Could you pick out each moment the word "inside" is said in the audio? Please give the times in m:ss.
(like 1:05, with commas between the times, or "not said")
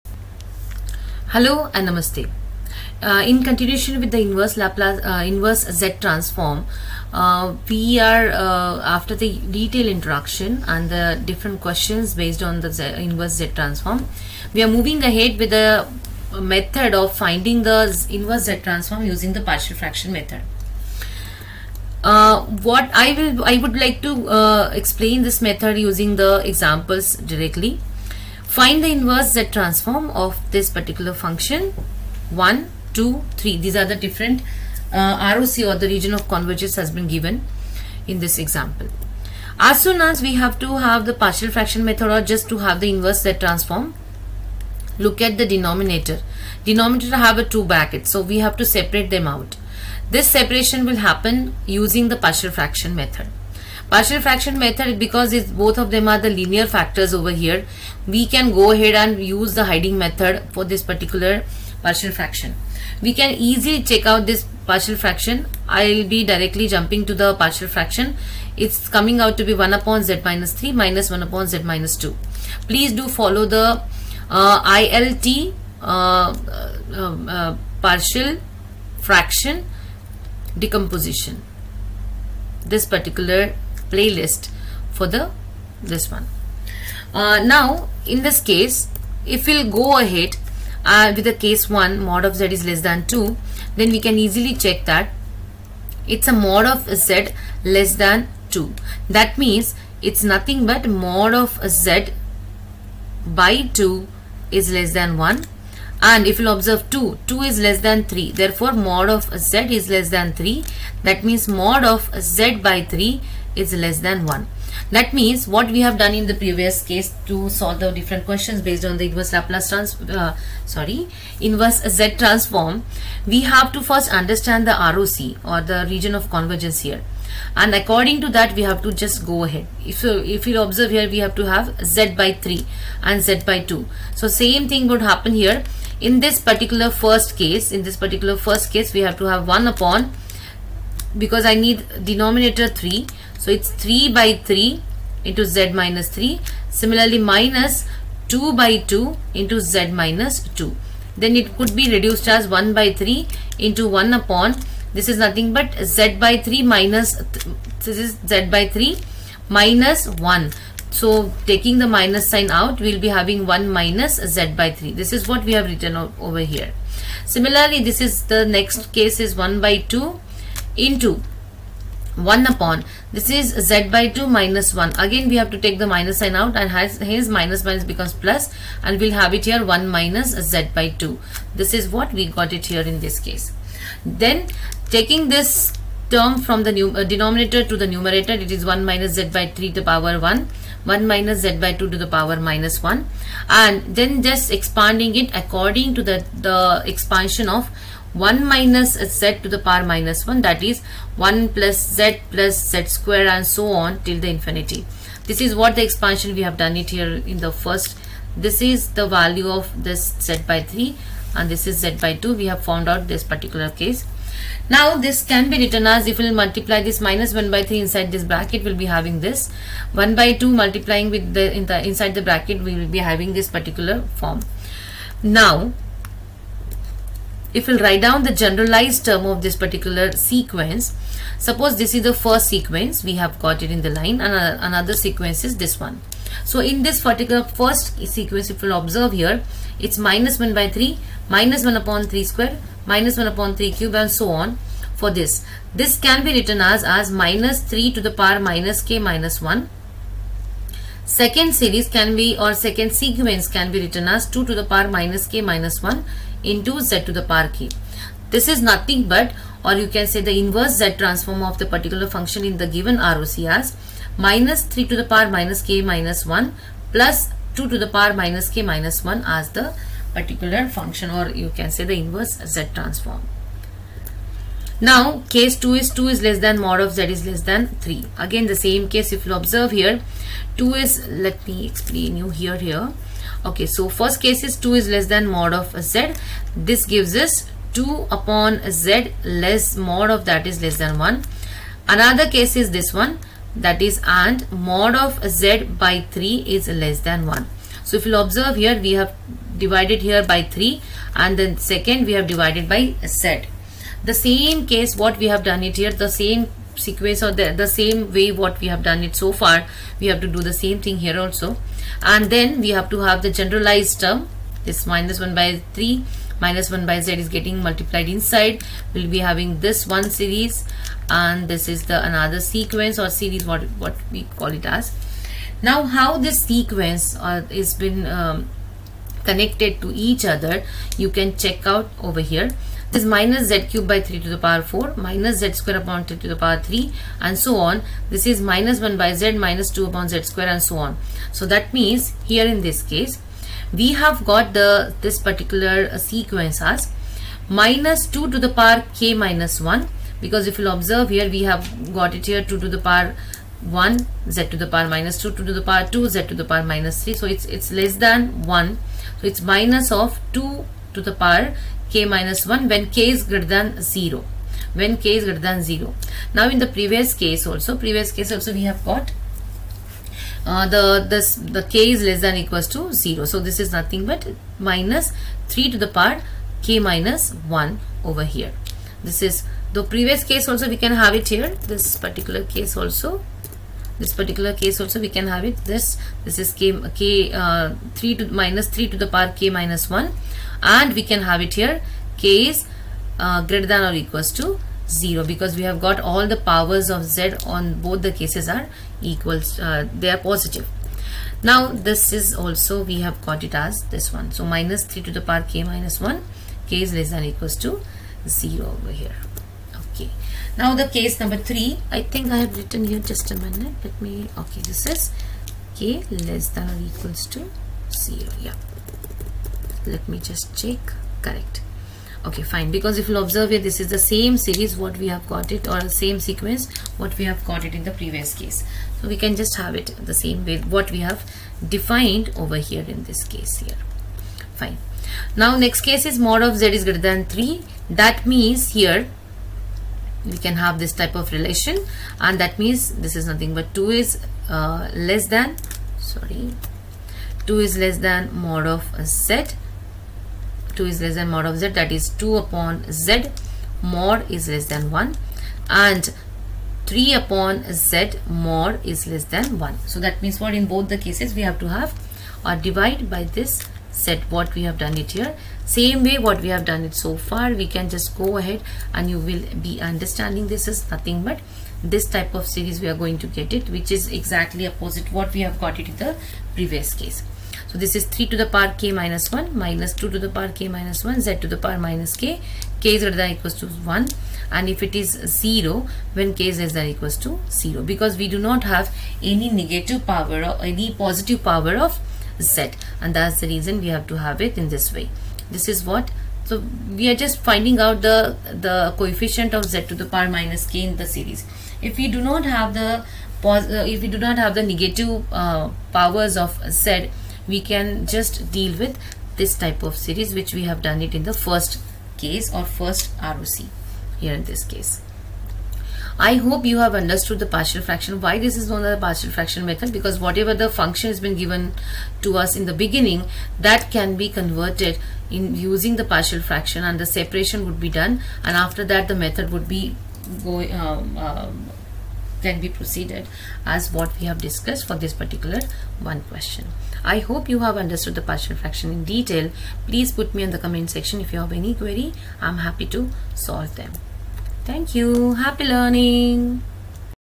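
3:37, 3:41, 5:18.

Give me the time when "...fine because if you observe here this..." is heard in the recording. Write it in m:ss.
7:02.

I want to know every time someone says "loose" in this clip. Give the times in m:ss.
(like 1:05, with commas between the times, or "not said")
not said.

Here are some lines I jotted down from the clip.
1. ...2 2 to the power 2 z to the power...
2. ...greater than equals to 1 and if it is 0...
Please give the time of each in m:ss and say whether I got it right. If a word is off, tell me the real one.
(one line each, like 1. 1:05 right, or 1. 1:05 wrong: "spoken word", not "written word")
1. 5:55 right
2. 8:03 right.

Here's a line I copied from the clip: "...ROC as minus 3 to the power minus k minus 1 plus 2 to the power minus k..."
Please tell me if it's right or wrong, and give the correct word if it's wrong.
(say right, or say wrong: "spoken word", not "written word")
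right.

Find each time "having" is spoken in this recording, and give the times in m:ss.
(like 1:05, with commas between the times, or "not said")
2:43, 3:38, 3:42, 5:19.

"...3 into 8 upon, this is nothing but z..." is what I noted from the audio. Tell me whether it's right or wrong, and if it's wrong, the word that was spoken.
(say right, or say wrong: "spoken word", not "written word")
wrong: "1", not "8".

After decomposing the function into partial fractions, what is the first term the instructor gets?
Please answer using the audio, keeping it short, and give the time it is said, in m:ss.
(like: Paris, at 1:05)
1 upon z minus 3, at 1:09.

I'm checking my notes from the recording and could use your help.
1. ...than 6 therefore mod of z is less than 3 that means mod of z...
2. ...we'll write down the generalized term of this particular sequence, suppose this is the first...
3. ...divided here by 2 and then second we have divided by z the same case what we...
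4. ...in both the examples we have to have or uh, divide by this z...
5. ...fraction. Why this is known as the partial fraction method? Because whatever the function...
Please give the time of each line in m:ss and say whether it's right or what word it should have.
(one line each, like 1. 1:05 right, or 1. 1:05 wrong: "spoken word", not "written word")
1. 1:47 wrong: "3", not "6"
2. 3:47 right
3. 4:59 wrong: "3", not "2"
4. 7:40 wrong: "cases", not "examples"
5. 8:37 right.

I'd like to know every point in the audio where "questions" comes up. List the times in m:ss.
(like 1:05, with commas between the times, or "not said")
0:11, 1:58, 8:56.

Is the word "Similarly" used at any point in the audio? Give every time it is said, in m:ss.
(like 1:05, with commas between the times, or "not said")
2:26, 2:47.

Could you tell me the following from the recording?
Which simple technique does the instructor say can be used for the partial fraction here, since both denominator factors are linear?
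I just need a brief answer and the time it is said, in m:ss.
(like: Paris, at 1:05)
hiding method, at 0:59.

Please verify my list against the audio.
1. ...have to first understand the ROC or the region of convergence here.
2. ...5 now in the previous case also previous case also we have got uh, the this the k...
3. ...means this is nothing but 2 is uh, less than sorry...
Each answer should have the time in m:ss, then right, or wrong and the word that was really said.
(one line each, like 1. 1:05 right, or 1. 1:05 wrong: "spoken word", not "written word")
1. 2:03 right
2. 6:05 wrong: "0", not "5"
3. 7:22 right.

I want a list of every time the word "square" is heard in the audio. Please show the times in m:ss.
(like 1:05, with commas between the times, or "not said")
3:22, 4:02, 5:35, 5:40.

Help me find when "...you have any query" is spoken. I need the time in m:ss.
9:01.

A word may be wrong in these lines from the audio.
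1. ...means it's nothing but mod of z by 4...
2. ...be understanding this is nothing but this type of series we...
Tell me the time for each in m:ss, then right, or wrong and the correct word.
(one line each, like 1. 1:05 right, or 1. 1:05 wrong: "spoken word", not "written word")
1. 1:39 wrong: "2", not "4"
2. 7:49 right.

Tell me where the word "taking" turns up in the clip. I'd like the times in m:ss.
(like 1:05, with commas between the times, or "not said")
2:41, 3:04.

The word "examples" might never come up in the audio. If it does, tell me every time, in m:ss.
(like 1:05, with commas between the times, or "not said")
0:26, 0:38.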